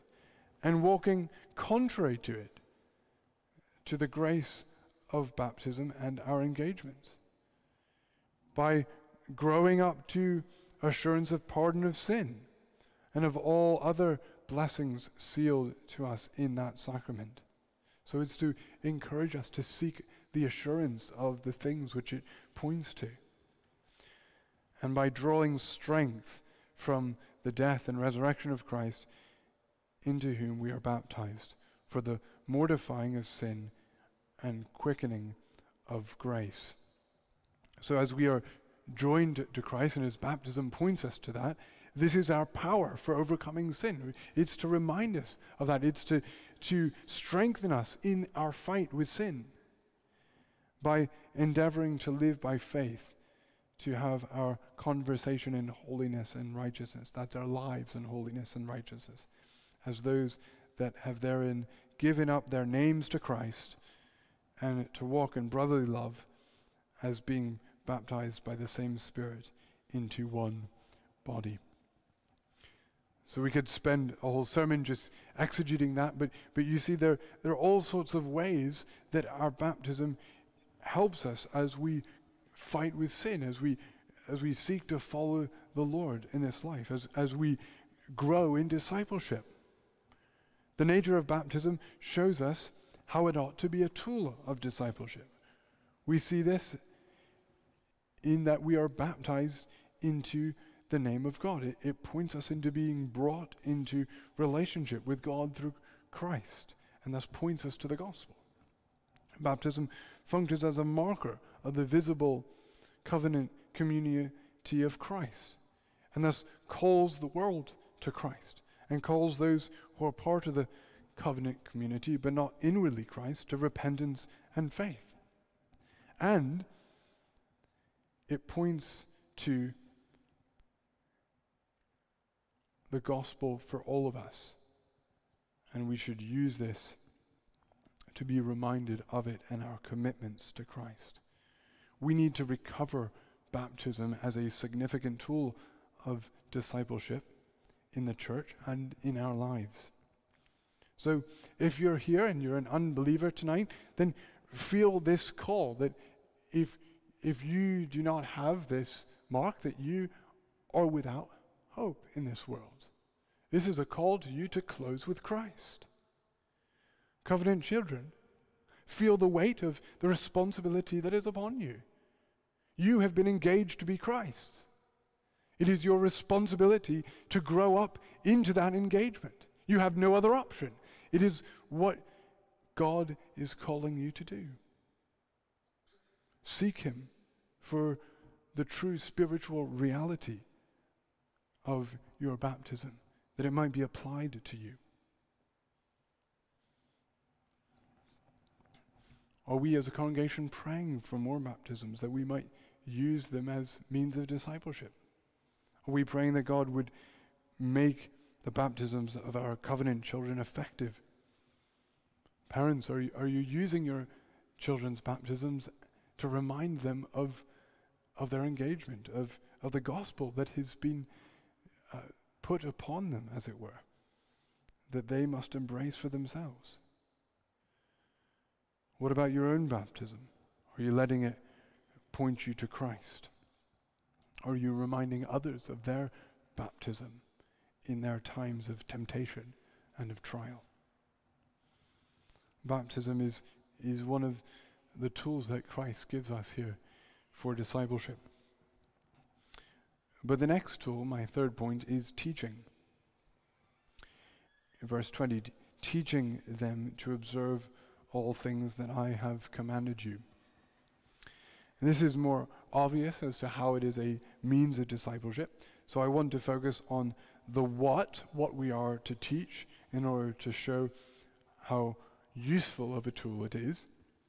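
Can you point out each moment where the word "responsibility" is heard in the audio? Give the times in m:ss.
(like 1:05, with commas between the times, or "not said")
2:50, 2:55.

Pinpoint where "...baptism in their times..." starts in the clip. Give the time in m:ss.
3:56.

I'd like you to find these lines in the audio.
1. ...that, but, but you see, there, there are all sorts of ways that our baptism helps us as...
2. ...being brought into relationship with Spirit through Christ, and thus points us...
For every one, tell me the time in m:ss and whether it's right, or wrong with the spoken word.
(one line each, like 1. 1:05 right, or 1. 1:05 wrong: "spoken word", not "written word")
1. 1:15 right
2. 1:42 wrong: "God", not "Spirit".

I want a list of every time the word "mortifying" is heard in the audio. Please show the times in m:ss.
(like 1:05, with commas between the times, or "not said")
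0:32.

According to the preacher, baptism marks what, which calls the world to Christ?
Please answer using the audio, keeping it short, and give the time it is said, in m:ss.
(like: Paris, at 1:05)
The visible covenant community, at 1:51.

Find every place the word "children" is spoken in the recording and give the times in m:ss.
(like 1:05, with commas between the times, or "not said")
2:47, 3:30, 3:34.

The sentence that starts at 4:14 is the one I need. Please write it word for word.
Verse 20 teaching them to observe all things that I have commanded you.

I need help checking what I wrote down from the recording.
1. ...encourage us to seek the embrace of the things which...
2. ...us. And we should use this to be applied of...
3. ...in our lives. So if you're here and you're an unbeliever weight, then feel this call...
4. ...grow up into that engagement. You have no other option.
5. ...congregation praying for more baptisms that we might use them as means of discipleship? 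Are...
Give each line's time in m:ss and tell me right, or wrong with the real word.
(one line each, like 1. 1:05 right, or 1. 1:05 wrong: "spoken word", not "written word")
1. 0:18 wrong: "assurance", not "embrace"
2. 2:14 wrong: "reminded", not "applied"
3. 2:29 wrong: "tonight", not "weight"
4. 2:57 right
5. 3:19 right.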